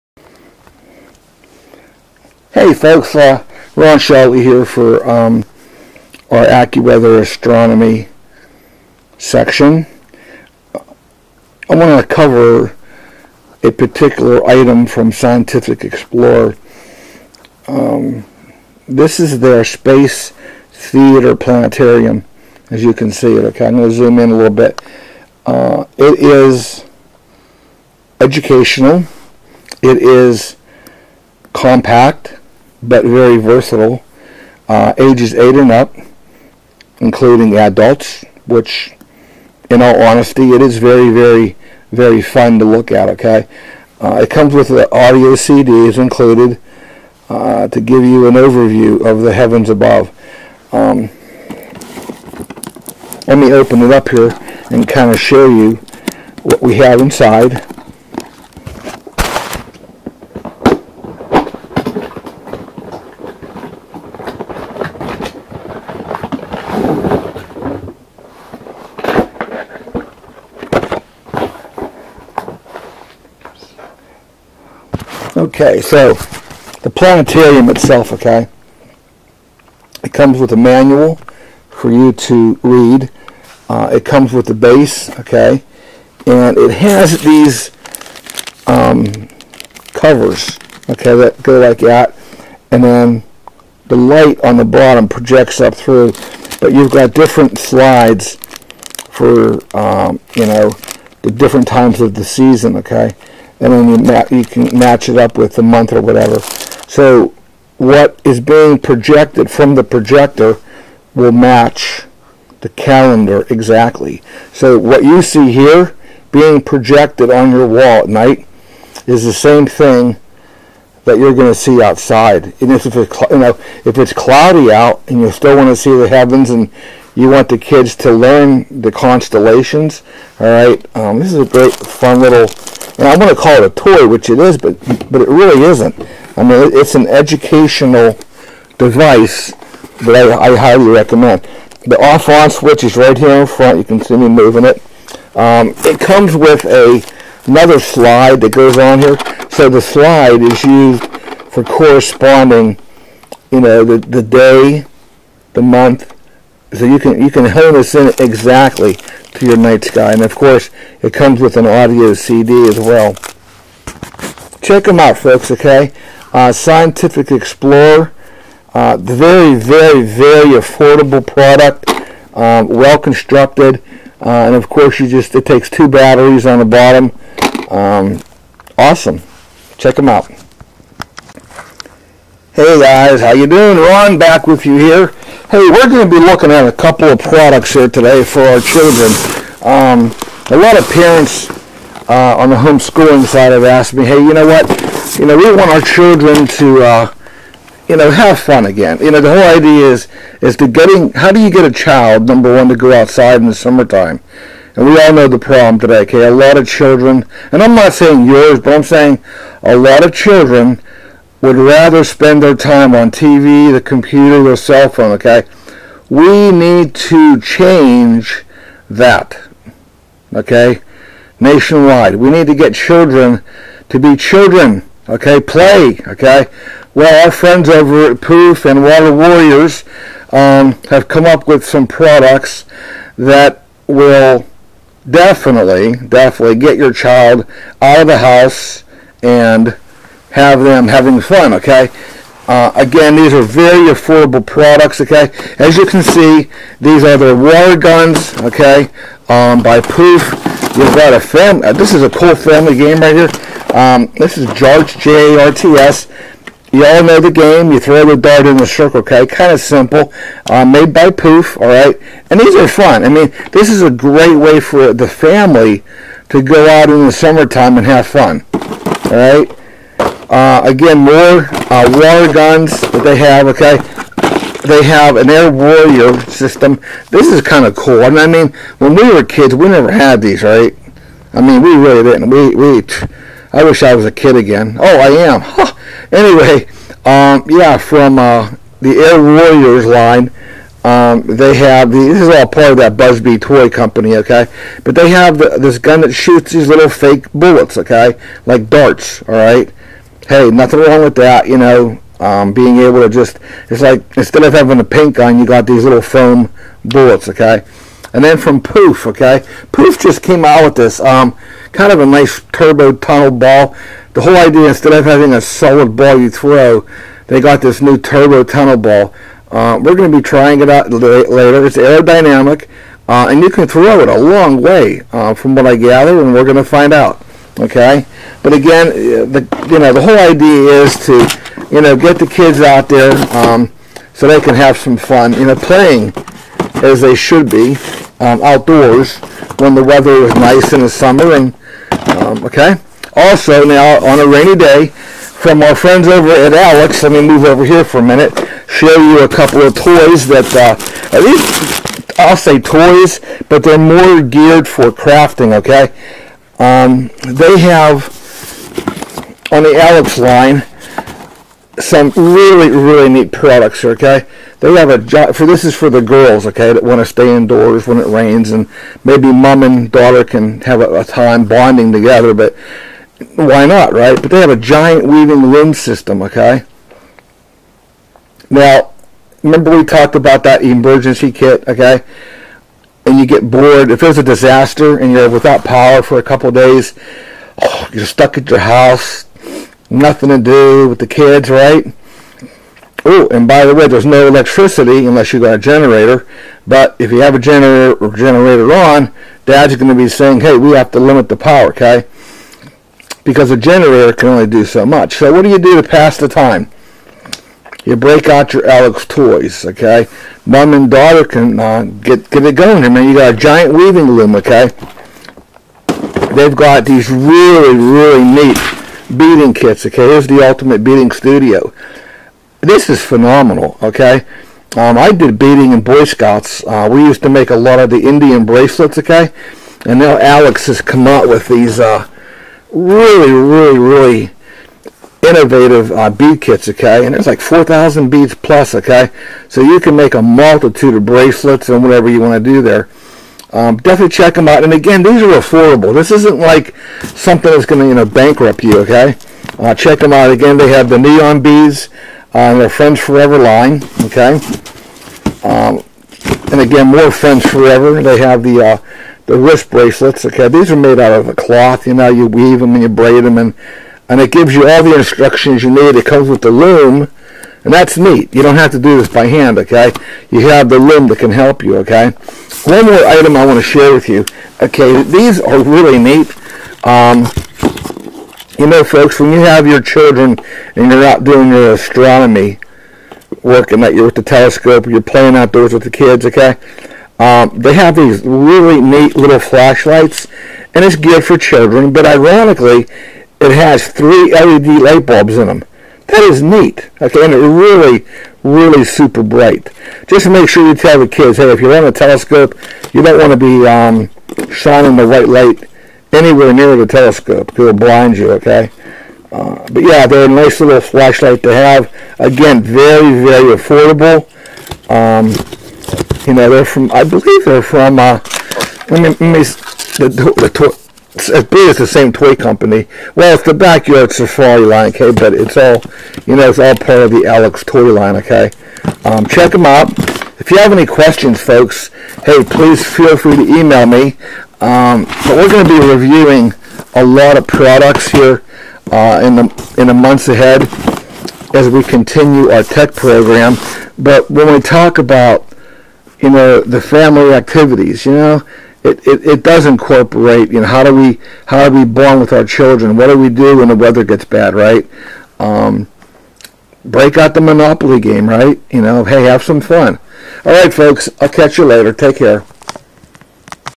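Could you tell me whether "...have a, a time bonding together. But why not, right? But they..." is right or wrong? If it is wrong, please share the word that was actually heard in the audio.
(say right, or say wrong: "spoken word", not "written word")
right.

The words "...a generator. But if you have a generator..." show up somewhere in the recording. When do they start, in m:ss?
6:35.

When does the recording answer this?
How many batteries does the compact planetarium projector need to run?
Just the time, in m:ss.
2:55.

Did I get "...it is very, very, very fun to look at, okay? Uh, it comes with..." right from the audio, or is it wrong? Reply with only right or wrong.
right.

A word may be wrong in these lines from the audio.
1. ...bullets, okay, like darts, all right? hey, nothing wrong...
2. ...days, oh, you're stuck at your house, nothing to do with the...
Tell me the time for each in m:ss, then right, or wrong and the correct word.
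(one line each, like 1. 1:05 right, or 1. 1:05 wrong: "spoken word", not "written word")
1. 4:57 right
2. 6:26 right.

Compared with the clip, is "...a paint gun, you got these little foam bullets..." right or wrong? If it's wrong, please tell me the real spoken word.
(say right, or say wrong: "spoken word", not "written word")
right.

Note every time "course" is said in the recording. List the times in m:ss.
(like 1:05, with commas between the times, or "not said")
2:40, 2:54.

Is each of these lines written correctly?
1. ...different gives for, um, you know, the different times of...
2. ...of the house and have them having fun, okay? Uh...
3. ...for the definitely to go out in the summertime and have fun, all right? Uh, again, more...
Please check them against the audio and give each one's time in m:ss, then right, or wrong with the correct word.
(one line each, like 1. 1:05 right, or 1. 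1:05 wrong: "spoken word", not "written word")
1. 1:37 wrong: "slides", not "gives"
2. 3:58 right
3. 4:24 wrong: "family", not "definitely".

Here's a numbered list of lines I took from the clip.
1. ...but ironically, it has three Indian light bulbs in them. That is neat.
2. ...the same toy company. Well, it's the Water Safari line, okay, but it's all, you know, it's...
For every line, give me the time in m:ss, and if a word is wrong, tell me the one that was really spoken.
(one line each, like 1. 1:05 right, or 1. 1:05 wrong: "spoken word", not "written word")
1. 8:11 wrong: "LED", not "Indian"
2. 8:41 wrong: "Backyard", not "Water".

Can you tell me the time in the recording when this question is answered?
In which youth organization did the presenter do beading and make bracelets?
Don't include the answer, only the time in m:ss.
7:05.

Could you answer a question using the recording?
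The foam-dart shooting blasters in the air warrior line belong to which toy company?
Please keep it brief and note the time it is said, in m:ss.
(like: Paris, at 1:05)
Buzz Bee, at 4:52.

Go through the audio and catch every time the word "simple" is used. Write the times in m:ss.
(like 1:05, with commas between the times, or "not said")
4:19.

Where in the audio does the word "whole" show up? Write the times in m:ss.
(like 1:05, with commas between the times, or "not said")
3:19, 5:14, 5:30.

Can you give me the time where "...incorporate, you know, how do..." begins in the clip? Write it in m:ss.
9:09.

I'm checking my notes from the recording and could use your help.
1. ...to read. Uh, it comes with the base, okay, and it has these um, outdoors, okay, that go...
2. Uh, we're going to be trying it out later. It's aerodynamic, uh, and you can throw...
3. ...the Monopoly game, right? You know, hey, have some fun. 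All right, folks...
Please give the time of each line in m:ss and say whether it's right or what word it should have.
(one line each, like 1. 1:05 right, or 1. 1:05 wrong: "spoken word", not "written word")
1. 1:22 wrong: "covers", not "outdoors"
2. 5:19 right
3. 9:17 right.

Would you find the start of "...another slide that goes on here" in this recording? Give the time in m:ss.
2:27.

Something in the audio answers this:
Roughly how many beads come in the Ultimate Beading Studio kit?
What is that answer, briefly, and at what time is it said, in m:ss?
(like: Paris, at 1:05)
4,000, at 7:17.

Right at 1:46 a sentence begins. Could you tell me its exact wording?
So what is being projected from the projector will match the calendar exactly.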